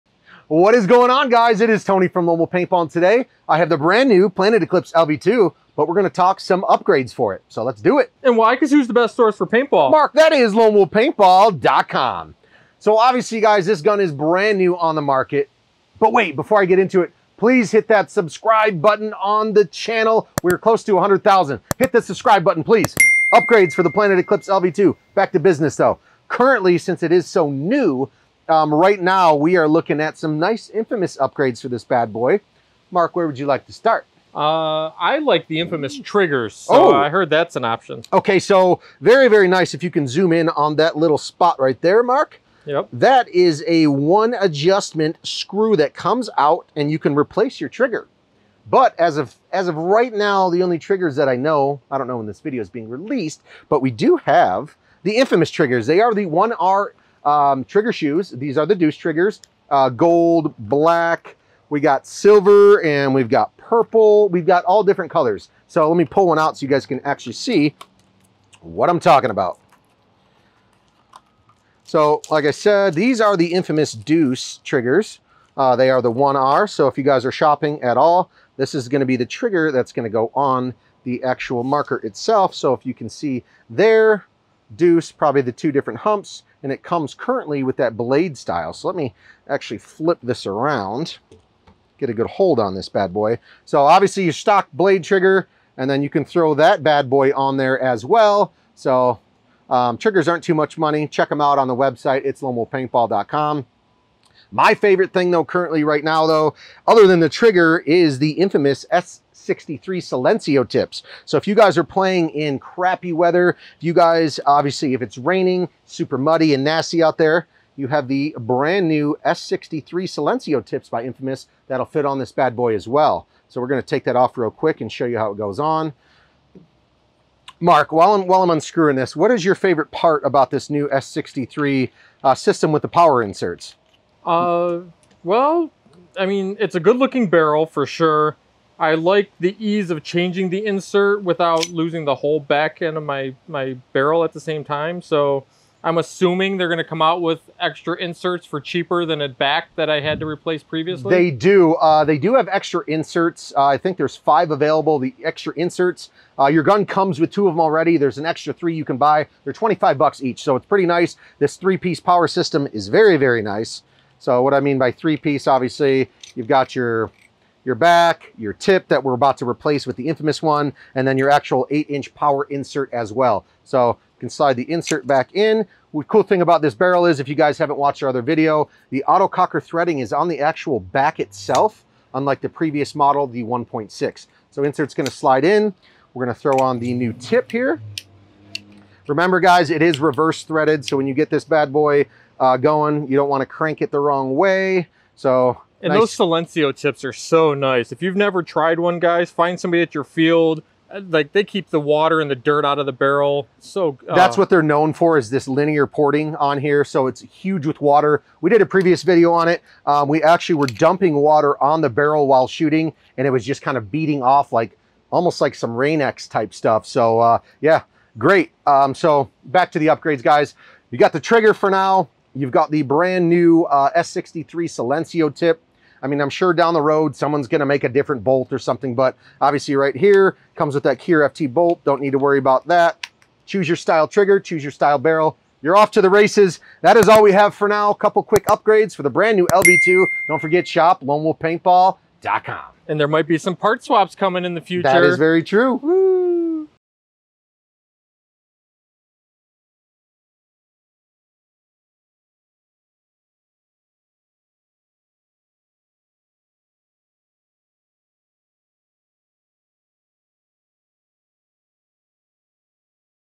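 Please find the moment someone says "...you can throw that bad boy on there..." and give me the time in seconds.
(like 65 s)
96 s.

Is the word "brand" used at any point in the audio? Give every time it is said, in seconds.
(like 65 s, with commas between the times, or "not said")
3 s, 14 s, 118 s, 222 s, 239 s.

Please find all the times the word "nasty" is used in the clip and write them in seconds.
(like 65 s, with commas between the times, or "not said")
116 s.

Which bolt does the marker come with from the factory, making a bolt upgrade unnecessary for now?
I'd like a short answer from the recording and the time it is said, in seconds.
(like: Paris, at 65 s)
Kier FT bolt, at 230 s.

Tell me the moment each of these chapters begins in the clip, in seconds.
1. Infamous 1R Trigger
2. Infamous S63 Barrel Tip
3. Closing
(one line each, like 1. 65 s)
1. 32 s
2. 104 s
3. 232 s.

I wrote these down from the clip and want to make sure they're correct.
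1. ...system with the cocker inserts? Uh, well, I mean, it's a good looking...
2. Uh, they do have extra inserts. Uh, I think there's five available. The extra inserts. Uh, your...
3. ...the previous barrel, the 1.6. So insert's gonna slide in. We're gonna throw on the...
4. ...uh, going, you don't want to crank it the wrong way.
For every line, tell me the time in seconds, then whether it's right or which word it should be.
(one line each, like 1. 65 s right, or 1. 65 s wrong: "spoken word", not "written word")
1. 132 s wrong: "power", not "cocker"
2. 151 s right
3. 182 s wrong: "model", not "barrel"
4. 192 s right.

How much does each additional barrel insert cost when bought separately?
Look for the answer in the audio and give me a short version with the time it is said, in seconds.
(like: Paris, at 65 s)
$25, at 159 s.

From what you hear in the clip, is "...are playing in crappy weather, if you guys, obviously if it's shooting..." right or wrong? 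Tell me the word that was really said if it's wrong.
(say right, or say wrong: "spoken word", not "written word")
wrong: "raining", not "shooting".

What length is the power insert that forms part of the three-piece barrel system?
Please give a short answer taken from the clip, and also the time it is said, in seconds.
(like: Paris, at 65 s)
8 inch, at 171 s.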